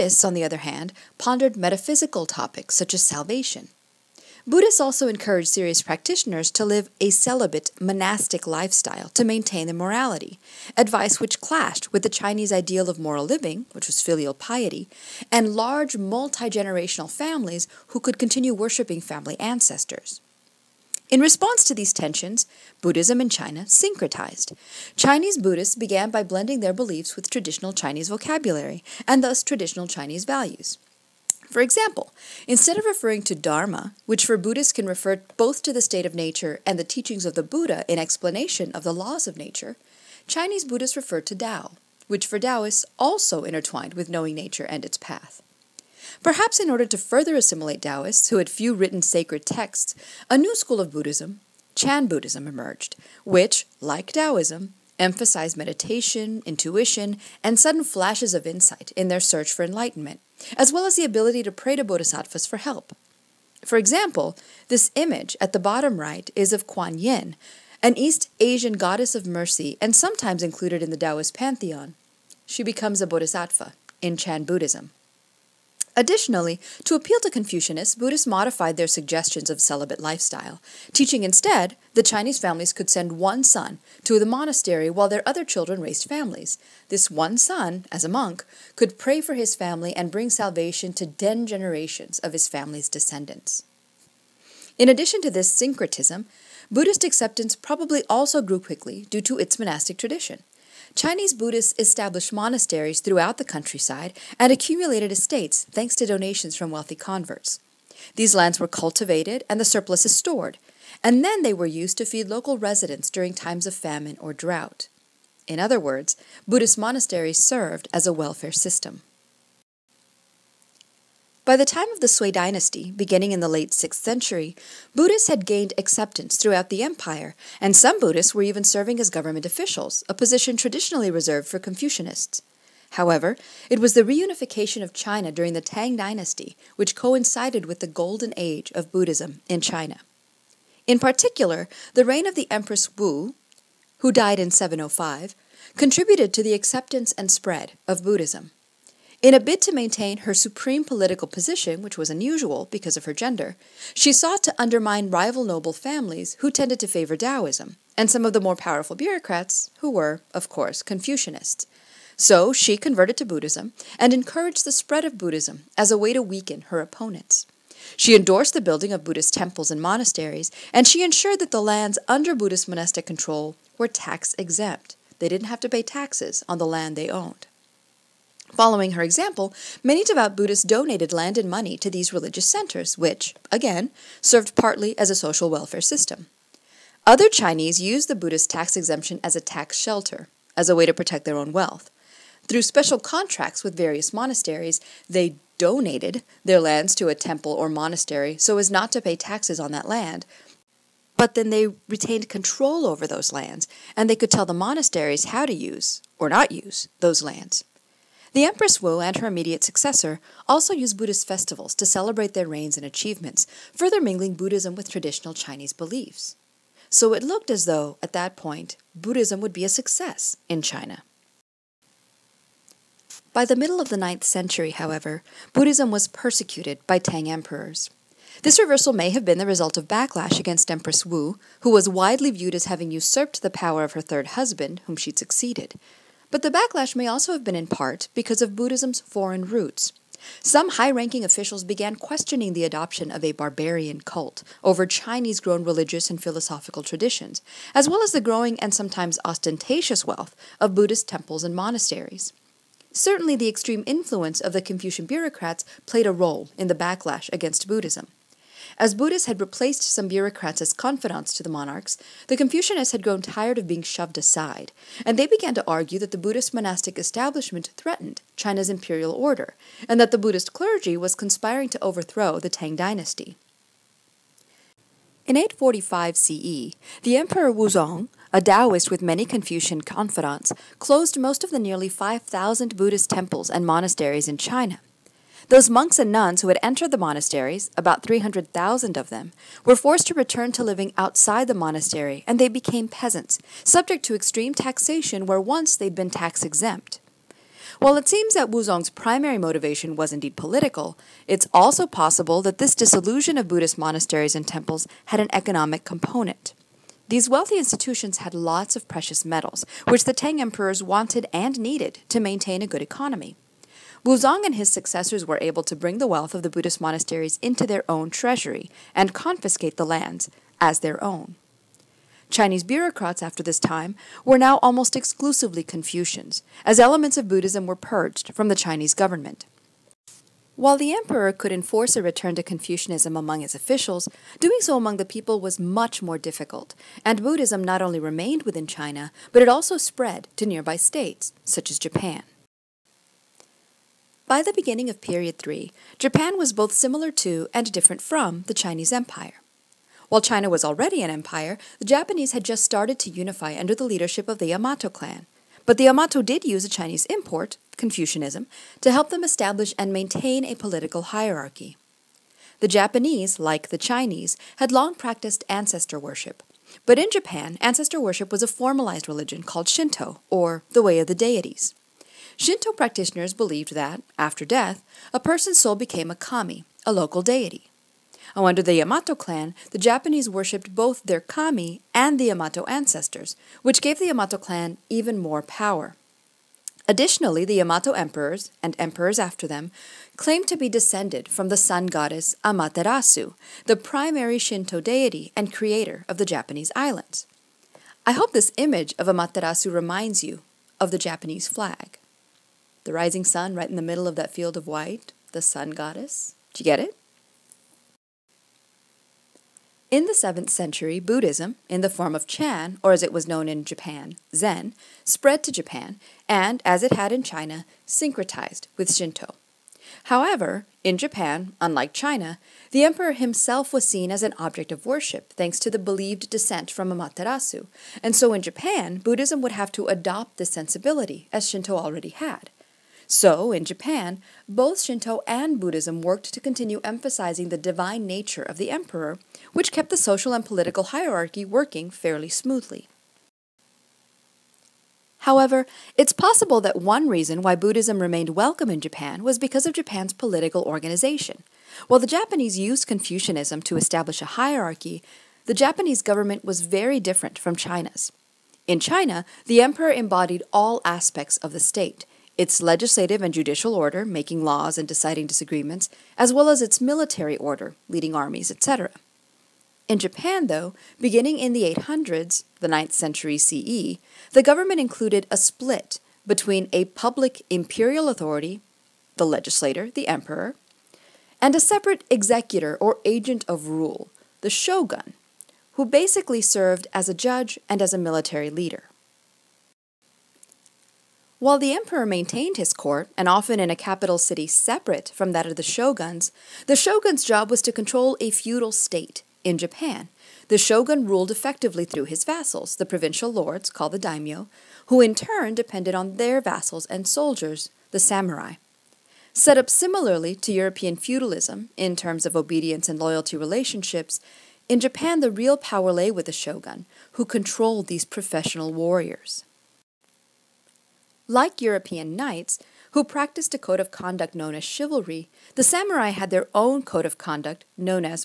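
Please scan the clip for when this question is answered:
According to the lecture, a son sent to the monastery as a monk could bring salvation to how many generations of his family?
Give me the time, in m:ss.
1:31.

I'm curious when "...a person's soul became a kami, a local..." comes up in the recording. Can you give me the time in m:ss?
6:15.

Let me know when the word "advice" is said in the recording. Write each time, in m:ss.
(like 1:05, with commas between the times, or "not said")
0:10.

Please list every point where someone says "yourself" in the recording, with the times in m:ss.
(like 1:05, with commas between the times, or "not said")
not said.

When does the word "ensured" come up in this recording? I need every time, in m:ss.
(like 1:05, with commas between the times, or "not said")
2:51.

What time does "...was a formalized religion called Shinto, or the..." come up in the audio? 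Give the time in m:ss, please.
6:08.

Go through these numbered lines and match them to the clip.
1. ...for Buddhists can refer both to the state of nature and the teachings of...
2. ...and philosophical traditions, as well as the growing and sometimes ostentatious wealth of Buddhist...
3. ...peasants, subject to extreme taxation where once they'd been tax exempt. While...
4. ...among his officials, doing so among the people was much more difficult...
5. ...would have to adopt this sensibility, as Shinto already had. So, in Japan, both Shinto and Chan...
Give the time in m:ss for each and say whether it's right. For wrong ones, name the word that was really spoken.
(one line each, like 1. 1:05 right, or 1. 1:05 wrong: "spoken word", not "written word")
1. 0:34 right
2. 4:06 right
3. 4:52 right
4. 5:33 right
5. 7:09 wrong: "Buddhism", not "Chan".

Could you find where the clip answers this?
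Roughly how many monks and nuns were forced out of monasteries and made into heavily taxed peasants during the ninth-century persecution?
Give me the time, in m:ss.
4:48.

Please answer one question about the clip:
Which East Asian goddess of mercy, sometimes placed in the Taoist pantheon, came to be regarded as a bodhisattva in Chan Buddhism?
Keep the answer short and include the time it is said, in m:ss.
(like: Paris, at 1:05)
Kuan Yin, at 1:06.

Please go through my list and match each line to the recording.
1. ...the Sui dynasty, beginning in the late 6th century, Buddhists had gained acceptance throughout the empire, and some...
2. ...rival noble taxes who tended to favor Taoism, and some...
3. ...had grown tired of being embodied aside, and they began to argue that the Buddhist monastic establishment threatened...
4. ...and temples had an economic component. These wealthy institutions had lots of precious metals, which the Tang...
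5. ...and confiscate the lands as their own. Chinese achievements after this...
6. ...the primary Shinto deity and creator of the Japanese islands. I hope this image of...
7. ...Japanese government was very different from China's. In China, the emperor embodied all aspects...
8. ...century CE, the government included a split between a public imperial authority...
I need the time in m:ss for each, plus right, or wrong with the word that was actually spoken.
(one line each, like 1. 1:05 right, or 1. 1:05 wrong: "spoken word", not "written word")
1. 2:01 right
2. 2:35 wrong: "families", not "taxes"
3. 4:22 wrong: "shoved", not "embodied"
4. 5:04 right
5. 5:18 wrong: "bureaucrats", not "achievements"
6. 6:33 right
7. 7:35 right
8. 7:52 right.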